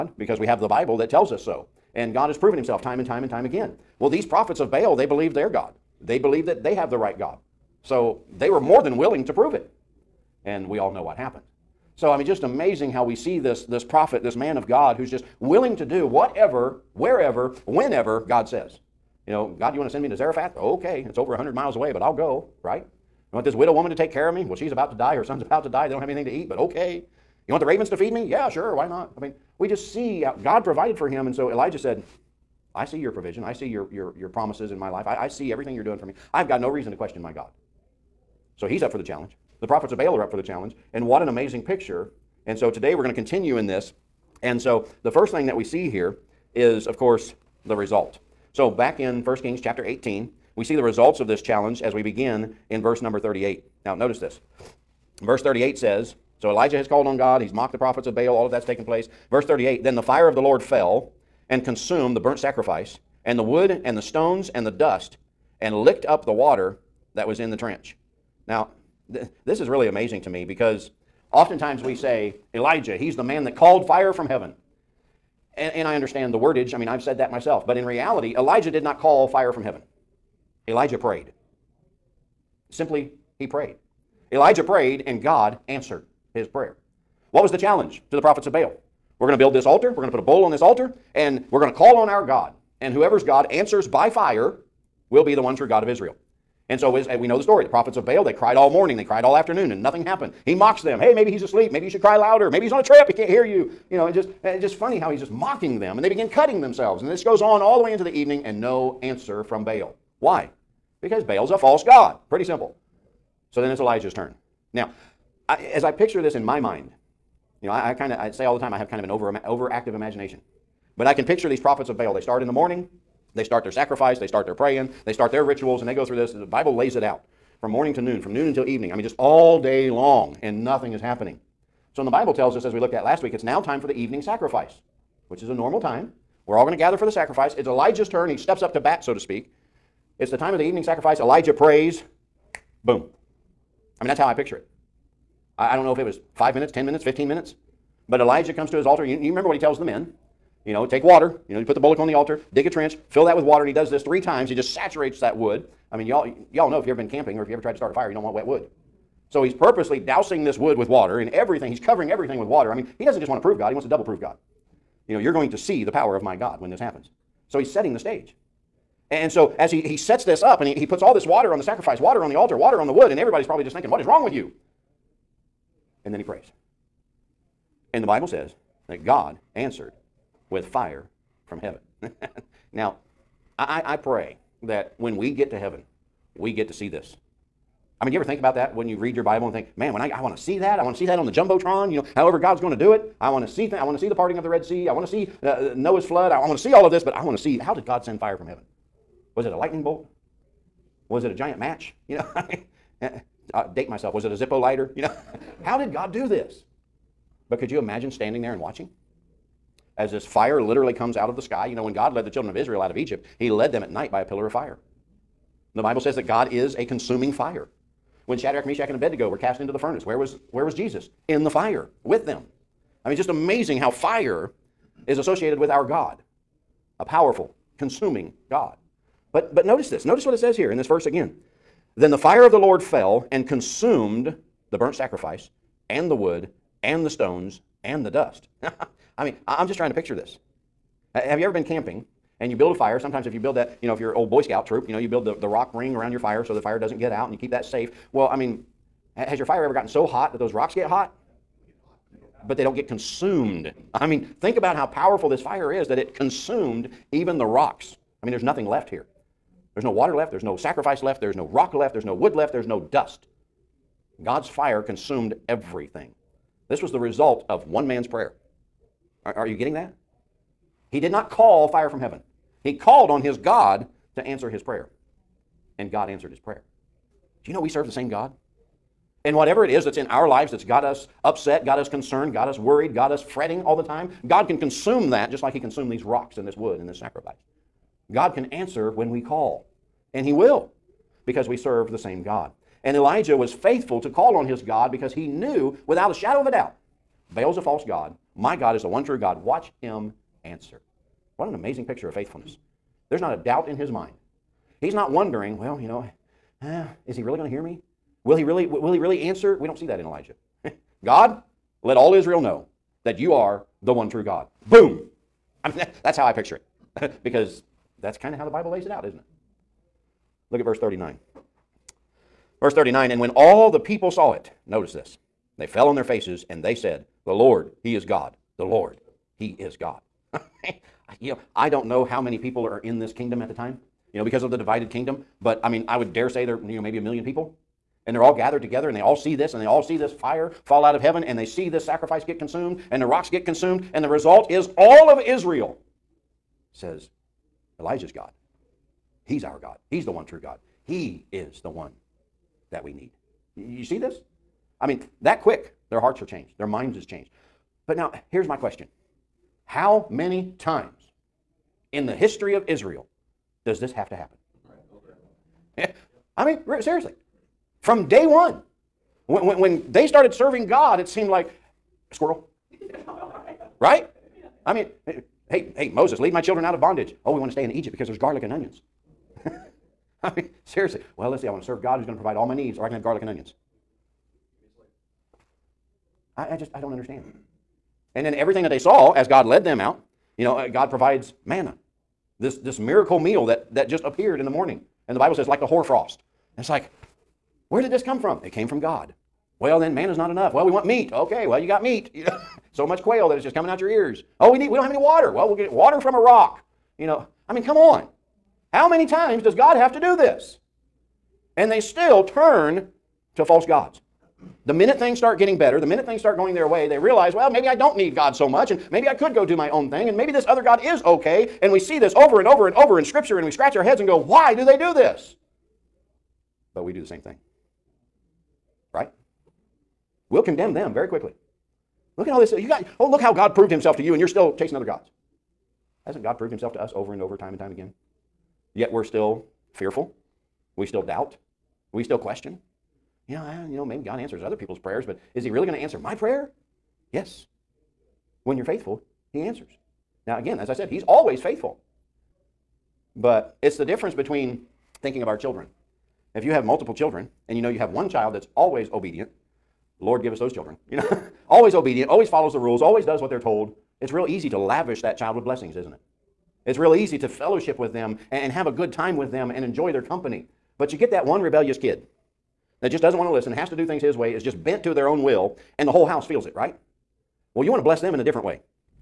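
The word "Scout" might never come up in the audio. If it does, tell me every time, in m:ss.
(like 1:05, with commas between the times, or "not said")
4:04.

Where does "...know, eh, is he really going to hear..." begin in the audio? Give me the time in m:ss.
5:05.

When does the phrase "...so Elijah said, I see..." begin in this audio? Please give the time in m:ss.
0:31.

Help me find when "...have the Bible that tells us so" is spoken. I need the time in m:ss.
0:00.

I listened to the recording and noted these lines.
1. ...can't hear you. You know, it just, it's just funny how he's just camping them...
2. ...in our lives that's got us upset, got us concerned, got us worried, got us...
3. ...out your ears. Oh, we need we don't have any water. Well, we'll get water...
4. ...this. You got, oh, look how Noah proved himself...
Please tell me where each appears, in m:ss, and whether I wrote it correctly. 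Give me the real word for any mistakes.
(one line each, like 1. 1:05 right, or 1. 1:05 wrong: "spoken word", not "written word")
1. 1:43 wrong: "mocking", not "camping"
2. 4:39 right
3. 6:43 right
4. 7:12 wrong: "God", not "Noah".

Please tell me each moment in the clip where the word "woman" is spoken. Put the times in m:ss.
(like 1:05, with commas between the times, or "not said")
0:23.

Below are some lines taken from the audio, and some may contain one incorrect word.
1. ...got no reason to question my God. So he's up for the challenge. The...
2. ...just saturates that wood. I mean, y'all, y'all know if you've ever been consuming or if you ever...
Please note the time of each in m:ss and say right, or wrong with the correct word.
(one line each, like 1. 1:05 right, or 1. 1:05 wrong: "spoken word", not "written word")
1. 0:36 right
2. 2:34 wrong: "camping", not "consuming".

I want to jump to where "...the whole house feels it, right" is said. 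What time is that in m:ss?
7:55.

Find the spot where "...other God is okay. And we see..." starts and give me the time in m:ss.
7:00.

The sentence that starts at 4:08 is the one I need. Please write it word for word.
Well, I mean, has your fire ever gotten so hot that those rocks get hot?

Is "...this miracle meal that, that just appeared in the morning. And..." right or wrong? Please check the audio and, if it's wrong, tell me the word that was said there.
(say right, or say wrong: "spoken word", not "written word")
right.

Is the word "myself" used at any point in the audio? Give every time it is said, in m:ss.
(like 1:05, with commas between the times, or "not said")
1:17, 3:23.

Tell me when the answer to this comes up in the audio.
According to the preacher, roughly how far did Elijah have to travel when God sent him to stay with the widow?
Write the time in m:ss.
0:21.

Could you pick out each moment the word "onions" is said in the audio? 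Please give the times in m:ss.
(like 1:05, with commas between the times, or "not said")
6:18, 6:23.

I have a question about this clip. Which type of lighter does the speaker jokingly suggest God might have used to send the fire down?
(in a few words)
Zippo.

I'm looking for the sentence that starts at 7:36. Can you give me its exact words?
If you have multiple children and you know you have one child that's always obedient, Lord, give us those children.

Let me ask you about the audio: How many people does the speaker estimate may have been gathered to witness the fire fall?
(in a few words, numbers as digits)
a million.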